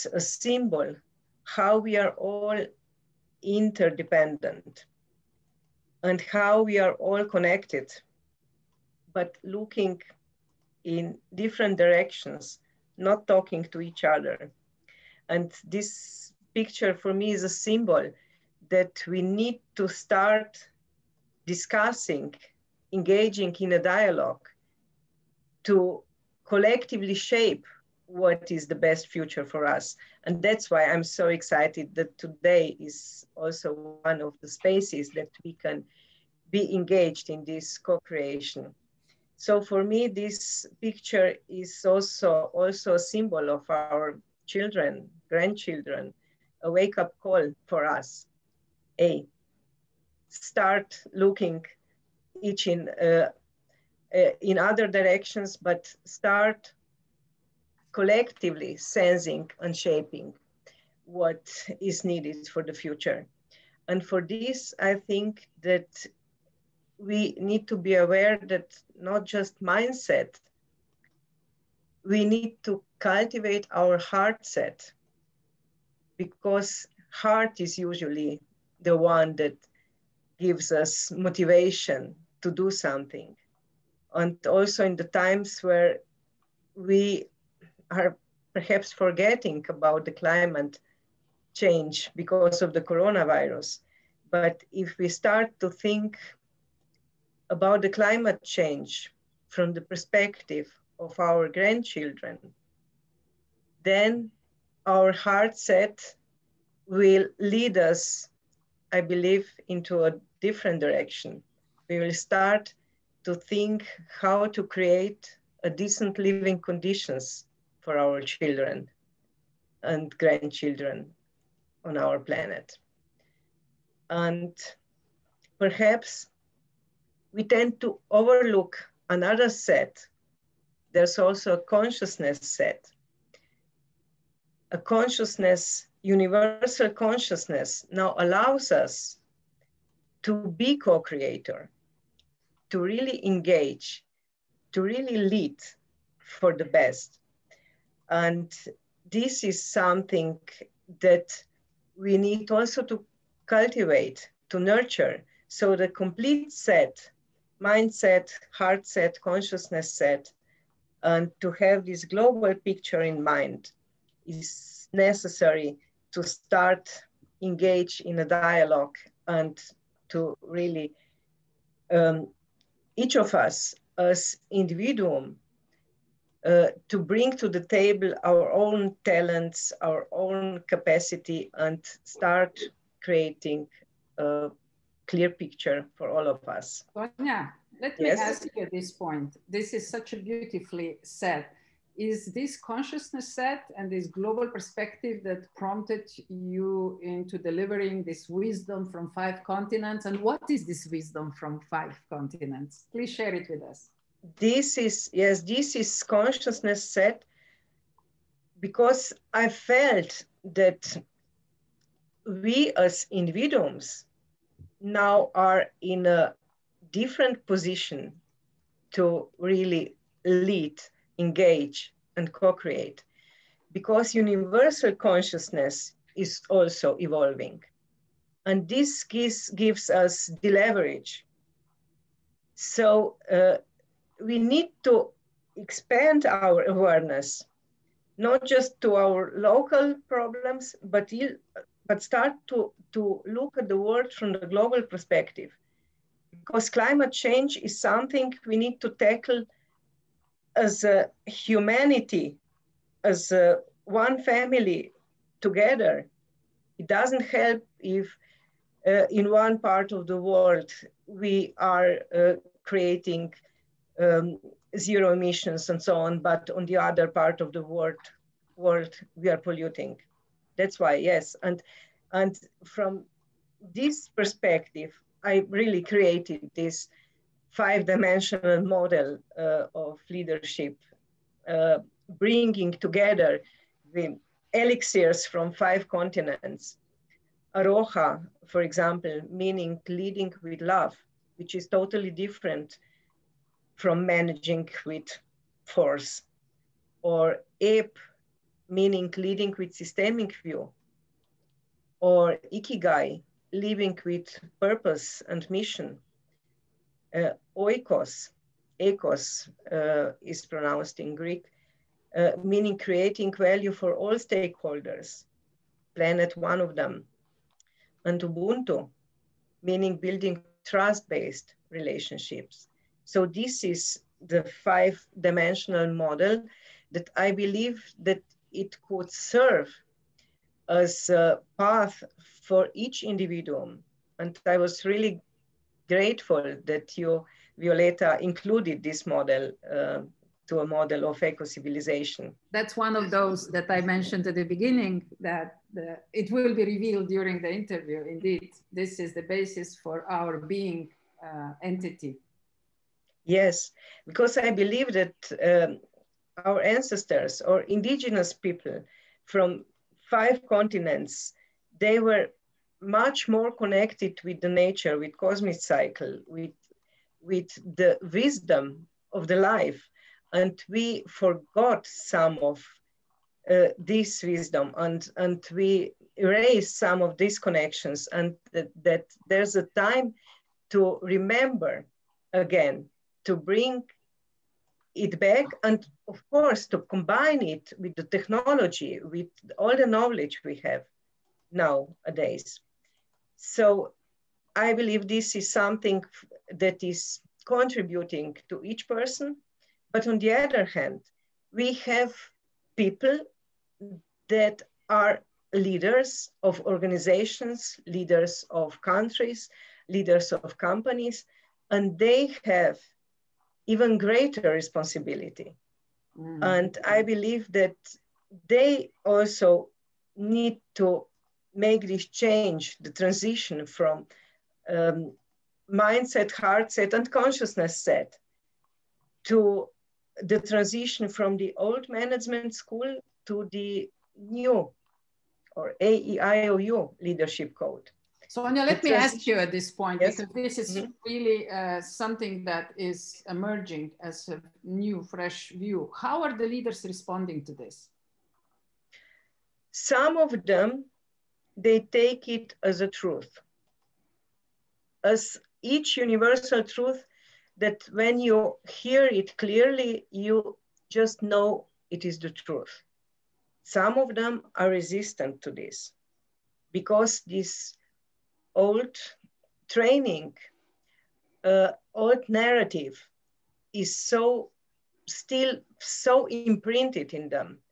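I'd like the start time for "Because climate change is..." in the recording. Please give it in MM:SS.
04:06.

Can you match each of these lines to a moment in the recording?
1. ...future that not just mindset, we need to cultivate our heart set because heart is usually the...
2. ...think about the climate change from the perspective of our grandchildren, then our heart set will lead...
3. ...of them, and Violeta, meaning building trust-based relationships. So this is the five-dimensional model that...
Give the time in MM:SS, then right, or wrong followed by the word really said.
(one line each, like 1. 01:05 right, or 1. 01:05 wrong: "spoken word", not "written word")
1. 01:07 wrong: "aware", not "future"
2. 01:35 right
3. 05:16 wrong: "Ubuntu", not "Violeta".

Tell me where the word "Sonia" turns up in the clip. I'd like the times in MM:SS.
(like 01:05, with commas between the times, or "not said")
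03:06, 07:18.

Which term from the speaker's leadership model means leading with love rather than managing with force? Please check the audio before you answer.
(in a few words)
Aroha.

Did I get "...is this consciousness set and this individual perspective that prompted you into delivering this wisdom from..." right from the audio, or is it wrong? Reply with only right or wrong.
wrong.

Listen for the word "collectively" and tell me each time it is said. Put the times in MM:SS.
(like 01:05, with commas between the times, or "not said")
00:26, 00:57.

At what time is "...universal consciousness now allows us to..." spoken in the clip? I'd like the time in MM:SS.
02:16.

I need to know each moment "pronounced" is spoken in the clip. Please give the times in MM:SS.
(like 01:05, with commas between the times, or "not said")
05:10.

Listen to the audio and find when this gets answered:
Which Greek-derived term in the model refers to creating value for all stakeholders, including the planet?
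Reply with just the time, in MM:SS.
05:07.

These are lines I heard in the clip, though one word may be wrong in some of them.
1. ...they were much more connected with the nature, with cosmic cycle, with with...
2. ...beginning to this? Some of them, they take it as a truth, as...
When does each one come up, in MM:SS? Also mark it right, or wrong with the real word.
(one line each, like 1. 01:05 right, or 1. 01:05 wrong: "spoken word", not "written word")
1. 06:01 right
2. 07:26 wrong: "responding", not "beginning".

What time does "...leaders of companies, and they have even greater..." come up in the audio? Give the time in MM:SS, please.
06:49.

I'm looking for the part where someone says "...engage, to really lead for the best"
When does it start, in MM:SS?
02:23.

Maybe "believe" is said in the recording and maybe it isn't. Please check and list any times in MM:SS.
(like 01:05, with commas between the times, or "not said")
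01:49, 05:27, 05:54, 06:34, 06:57.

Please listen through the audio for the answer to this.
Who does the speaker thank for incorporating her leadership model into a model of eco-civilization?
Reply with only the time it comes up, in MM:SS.
05:37.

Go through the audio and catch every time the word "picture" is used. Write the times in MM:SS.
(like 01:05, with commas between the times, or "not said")
00:16, 00:40, 02:42, 03:05.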